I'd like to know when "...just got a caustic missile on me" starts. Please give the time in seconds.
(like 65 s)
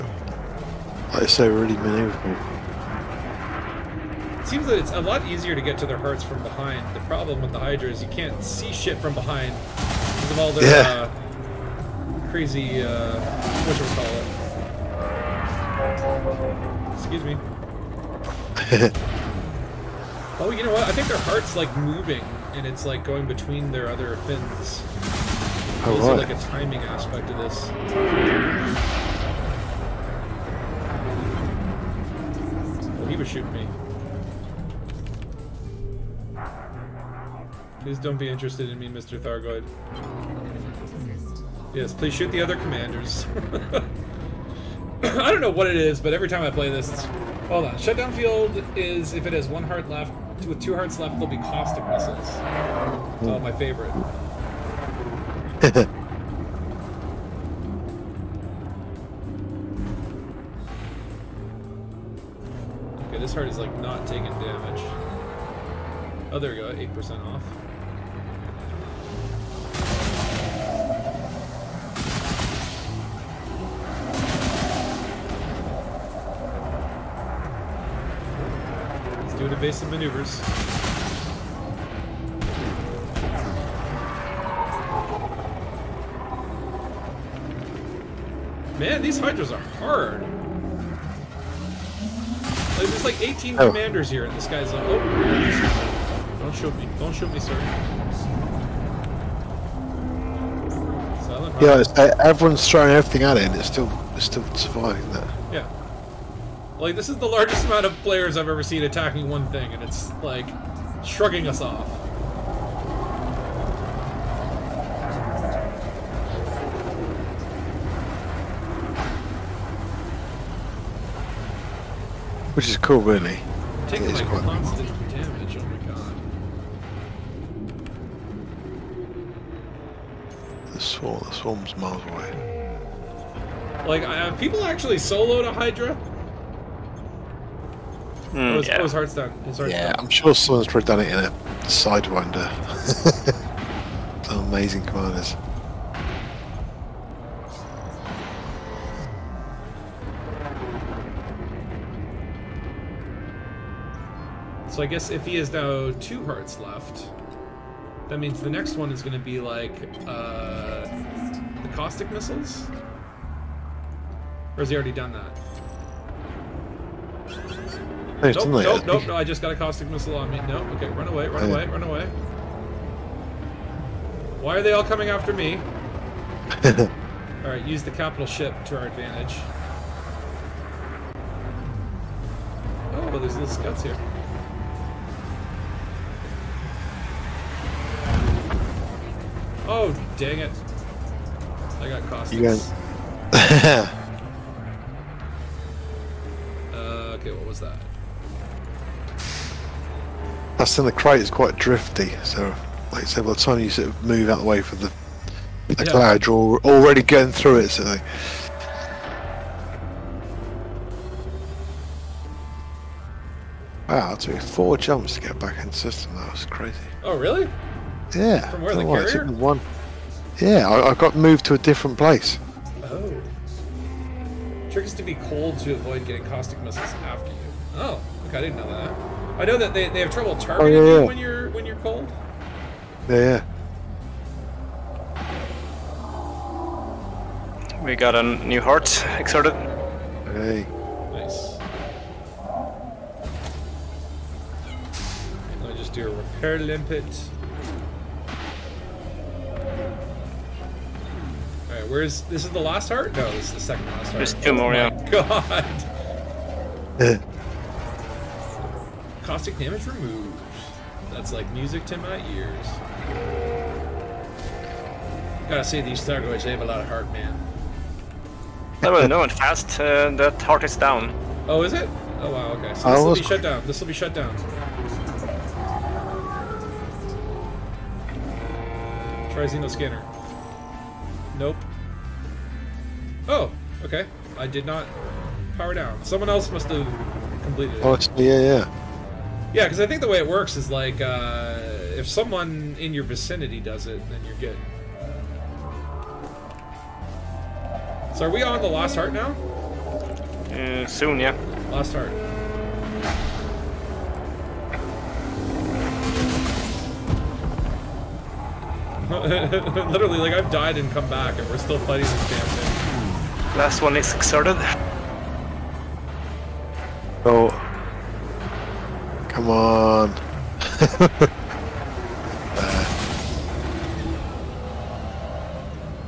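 169 s.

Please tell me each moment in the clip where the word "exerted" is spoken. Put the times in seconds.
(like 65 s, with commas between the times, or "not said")
239 s, 314 s.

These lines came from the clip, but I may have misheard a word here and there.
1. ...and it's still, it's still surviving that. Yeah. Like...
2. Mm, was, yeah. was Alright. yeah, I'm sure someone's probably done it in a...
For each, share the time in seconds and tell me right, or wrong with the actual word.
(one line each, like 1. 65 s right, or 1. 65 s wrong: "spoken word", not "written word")
1. 103 s right
2. 138 s wrong: "Hearthstone", not "Alright".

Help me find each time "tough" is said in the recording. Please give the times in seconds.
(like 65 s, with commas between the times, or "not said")
not said.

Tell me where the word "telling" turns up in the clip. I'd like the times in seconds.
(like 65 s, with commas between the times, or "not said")
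not said.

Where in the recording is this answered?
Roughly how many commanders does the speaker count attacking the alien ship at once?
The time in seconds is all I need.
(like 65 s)
93 s.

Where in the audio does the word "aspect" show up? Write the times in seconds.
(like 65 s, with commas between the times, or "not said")
26 s.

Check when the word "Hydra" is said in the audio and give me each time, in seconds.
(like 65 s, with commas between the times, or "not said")
7 s, 89 s, 135 s.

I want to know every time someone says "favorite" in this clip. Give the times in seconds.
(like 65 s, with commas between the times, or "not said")
53 s.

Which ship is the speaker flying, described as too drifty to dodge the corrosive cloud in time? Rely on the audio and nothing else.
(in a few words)
Krait.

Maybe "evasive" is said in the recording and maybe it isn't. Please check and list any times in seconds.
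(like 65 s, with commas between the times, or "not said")
79 s.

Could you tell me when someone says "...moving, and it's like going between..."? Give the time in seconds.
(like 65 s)
21 s.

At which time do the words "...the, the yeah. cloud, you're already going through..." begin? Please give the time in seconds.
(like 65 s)
204 s.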